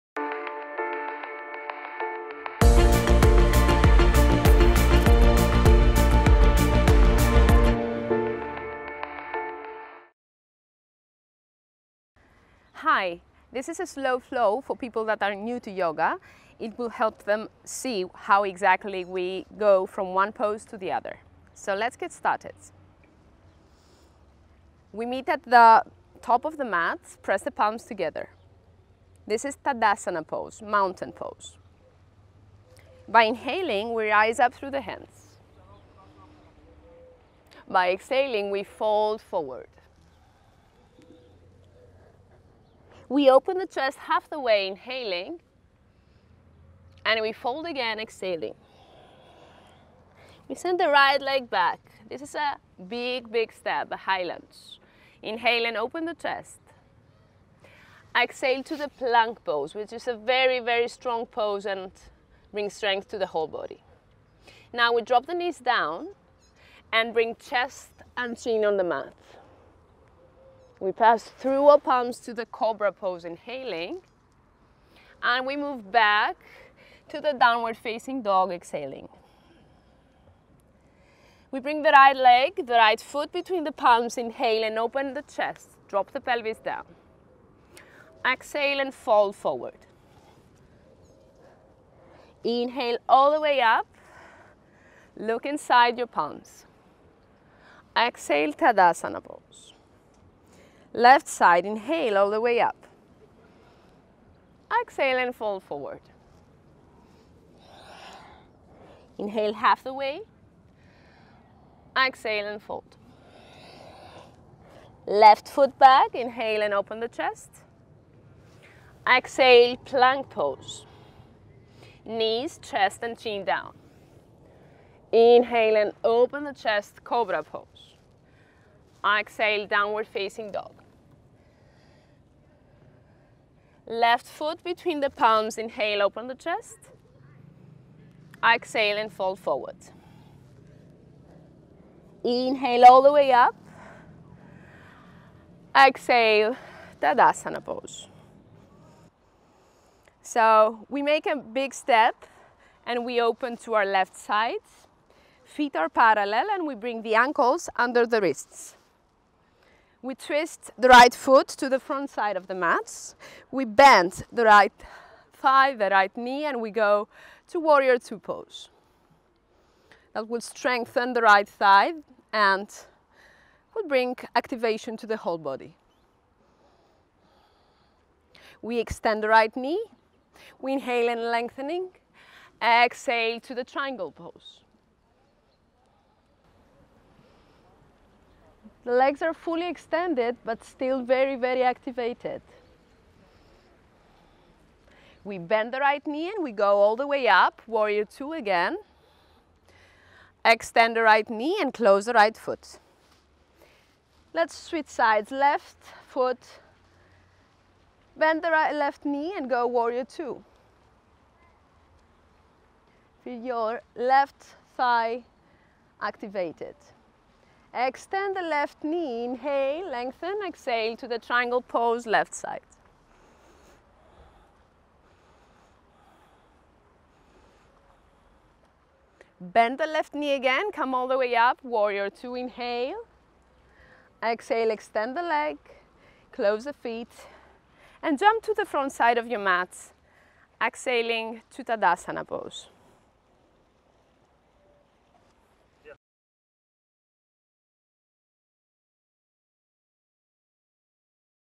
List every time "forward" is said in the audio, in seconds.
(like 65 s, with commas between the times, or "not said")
39 s, 89 s, 105 s, 139 s.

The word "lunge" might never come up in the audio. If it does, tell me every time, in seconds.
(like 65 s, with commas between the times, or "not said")
54 s.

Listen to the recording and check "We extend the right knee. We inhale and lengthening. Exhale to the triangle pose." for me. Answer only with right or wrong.
right.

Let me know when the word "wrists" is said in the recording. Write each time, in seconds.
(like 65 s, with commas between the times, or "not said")
158 s.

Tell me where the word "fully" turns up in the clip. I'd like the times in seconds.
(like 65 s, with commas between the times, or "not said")
189 s.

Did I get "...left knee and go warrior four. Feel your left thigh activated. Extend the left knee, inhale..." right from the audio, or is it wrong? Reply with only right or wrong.
wrong.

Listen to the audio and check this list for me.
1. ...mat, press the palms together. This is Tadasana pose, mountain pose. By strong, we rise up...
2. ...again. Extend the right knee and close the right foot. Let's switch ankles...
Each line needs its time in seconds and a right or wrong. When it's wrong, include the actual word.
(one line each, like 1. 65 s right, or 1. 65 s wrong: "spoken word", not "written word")
1. 26 s wrong: "inhaling", not "strong"
2. 198 s wrong: "sides", not "ankles".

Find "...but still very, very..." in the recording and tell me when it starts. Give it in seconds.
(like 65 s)
190 s.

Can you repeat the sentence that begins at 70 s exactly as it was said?
We pass through our palms to the cobra pose, inhaling.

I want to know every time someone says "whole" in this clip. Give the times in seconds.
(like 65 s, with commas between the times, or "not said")
63 s, 175 s.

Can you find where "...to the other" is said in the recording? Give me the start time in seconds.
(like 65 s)
20 s.